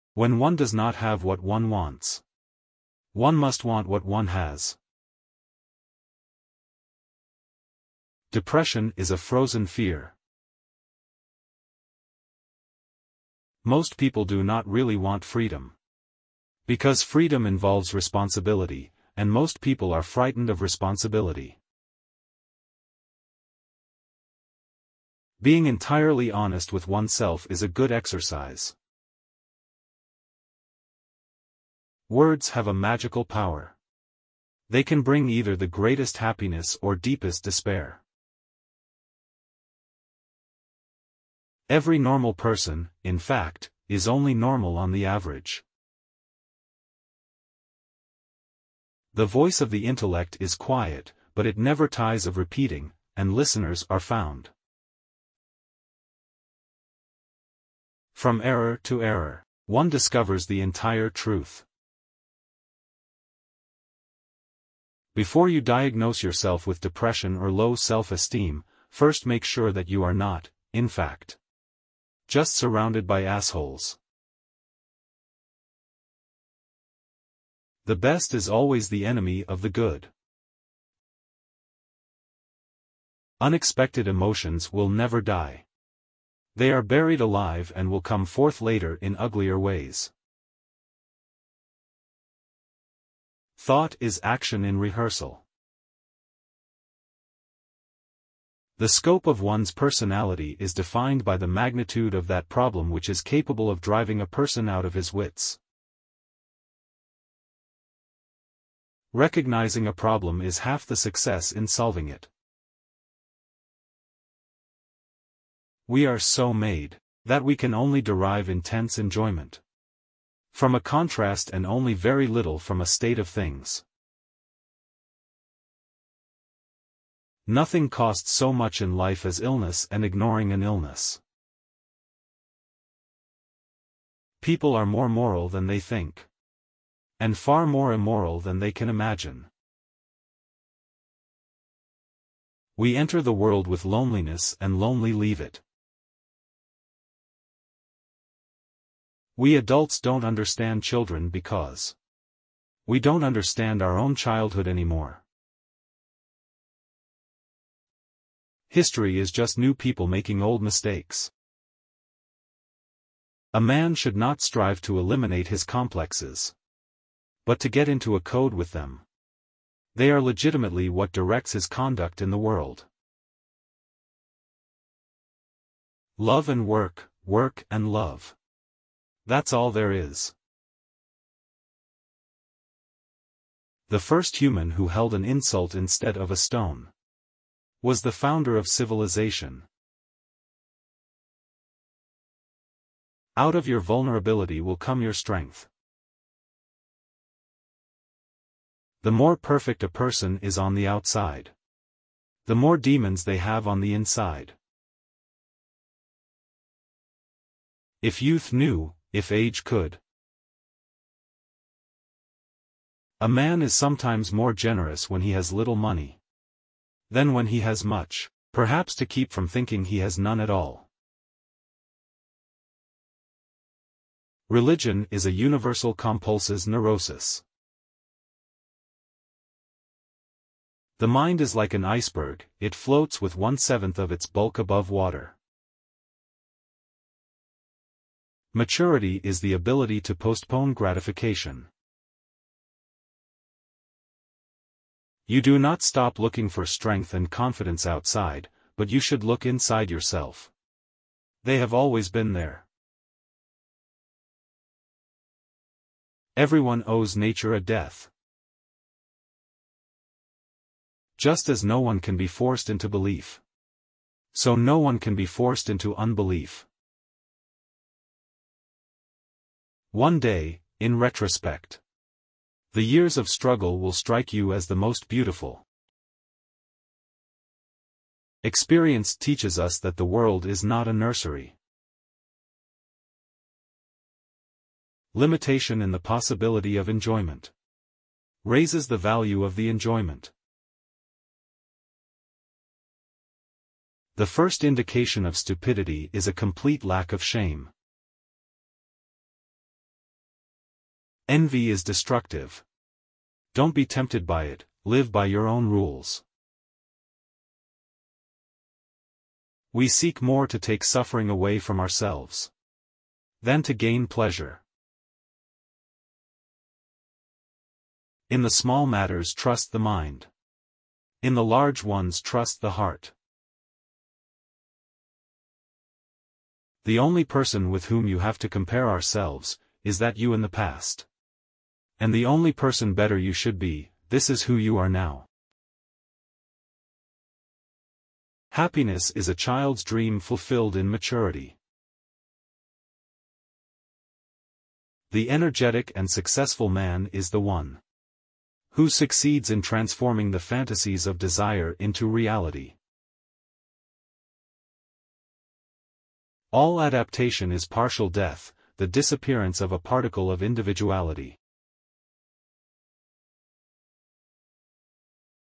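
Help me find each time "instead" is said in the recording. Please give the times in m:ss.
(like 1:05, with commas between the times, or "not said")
3:05.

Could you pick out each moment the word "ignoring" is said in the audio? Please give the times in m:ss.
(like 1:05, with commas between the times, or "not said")
2:10.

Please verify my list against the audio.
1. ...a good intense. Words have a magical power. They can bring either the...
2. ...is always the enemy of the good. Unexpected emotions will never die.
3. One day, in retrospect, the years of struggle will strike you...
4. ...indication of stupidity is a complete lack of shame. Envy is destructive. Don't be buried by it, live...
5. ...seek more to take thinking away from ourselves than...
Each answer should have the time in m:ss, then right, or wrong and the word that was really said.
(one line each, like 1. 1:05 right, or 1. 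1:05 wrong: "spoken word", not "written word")
1. 0:27 wrong: "exercise", not "intense"
2. 1:18 right
3. 4:29 right
4. 4:54 wrong: "tempted", not "buried"
5. 5:09 wrong: "suffering", not "thinking".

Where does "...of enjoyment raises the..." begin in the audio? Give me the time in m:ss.
4:46.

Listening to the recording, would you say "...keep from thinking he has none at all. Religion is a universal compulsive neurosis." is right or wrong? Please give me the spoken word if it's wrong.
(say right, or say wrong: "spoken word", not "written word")
right.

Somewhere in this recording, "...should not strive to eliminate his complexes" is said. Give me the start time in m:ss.
2:43.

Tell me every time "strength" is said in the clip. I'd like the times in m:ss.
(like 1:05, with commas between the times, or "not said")
3:15, 4:06.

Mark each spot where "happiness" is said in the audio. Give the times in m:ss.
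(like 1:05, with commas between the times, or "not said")
0:36, 5:38.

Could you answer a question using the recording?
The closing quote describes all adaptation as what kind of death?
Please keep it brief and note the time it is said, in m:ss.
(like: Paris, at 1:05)
partial death, at 5:57.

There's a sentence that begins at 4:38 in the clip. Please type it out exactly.
Experience teaches us that the world is not a nursery.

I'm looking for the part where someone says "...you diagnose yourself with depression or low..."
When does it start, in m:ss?
1:05.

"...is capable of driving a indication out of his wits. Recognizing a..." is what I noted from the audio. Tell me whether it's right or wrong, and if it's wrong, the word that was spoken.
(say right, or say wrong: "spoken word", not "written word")
wrong: "person", not "indication".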